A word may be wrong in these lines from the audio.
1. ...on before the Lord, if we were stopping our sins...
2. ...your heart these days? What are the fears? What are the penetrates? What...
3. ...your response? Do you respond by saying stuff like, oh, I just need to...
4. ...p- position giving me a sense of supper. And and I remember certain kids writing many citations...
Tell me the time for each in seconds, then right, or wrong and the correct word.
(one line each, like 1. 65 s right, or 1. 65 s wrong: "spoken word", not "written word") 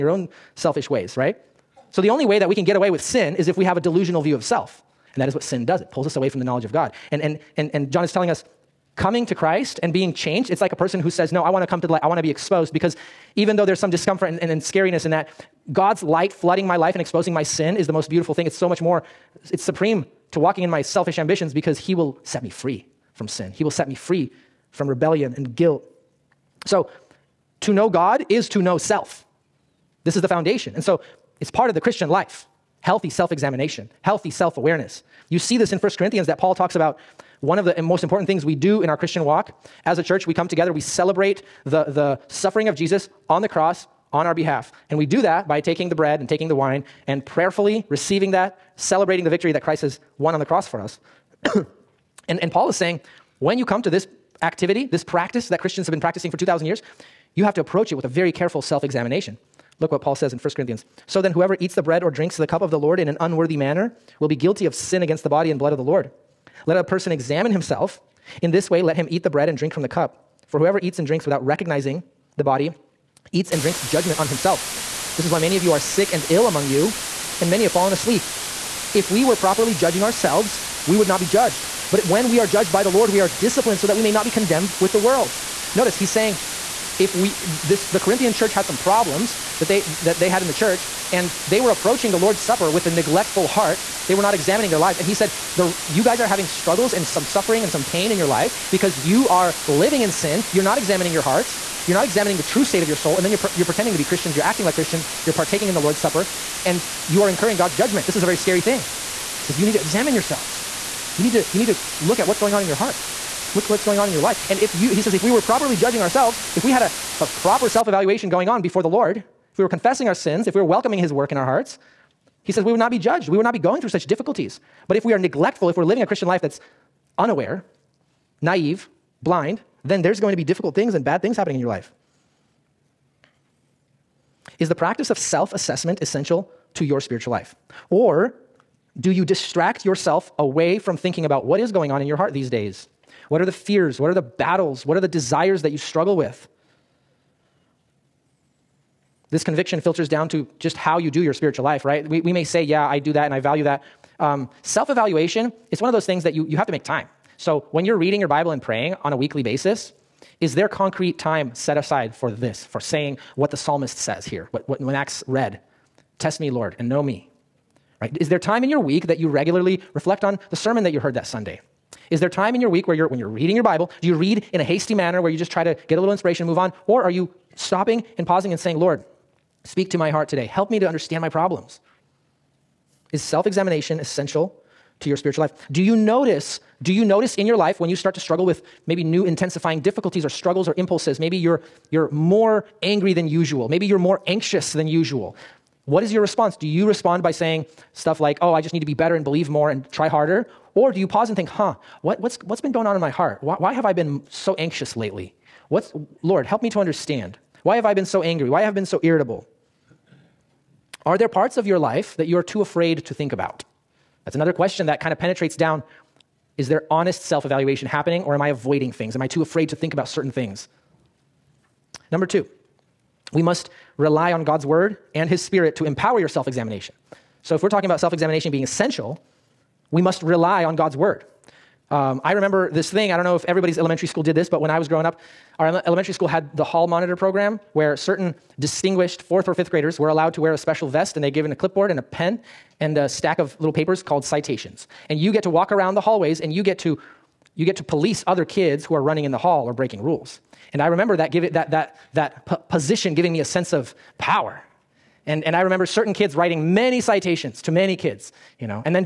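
1. 118 s wrong: "confessing", not "stopping"
2. 142 s wrong: "battles", not "penetrates"
3. 196 s right
4. 252 s wrong: "power", not "supper".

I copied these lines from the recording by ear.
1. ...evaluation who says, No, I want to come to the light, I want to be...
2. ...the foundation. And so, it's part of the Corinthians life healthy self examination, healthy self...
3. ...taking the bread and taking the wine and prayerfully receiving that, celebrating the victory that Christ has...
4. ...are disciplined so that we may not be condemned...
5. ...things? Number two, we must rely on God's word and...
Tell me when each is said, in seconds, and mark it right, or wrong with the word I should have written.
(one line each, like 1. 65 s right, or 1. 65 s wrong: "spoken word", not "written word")
1. 10 s wrong: "person", not "evaluation"
2. 30 s wrong: "Christian", not "Corinthians"
3. 45 s right
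4. 83 s right
5. 220 s right.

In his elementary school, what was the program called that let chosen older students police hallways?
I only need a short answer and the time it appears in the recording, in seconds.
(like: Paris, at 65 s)
hall monitor program, at 236 s.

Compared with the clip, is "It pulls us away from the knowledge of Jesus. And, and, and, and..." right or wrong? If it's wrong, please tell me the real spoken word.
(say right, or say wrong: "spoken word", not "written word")
wrong: "God", not "Jesus".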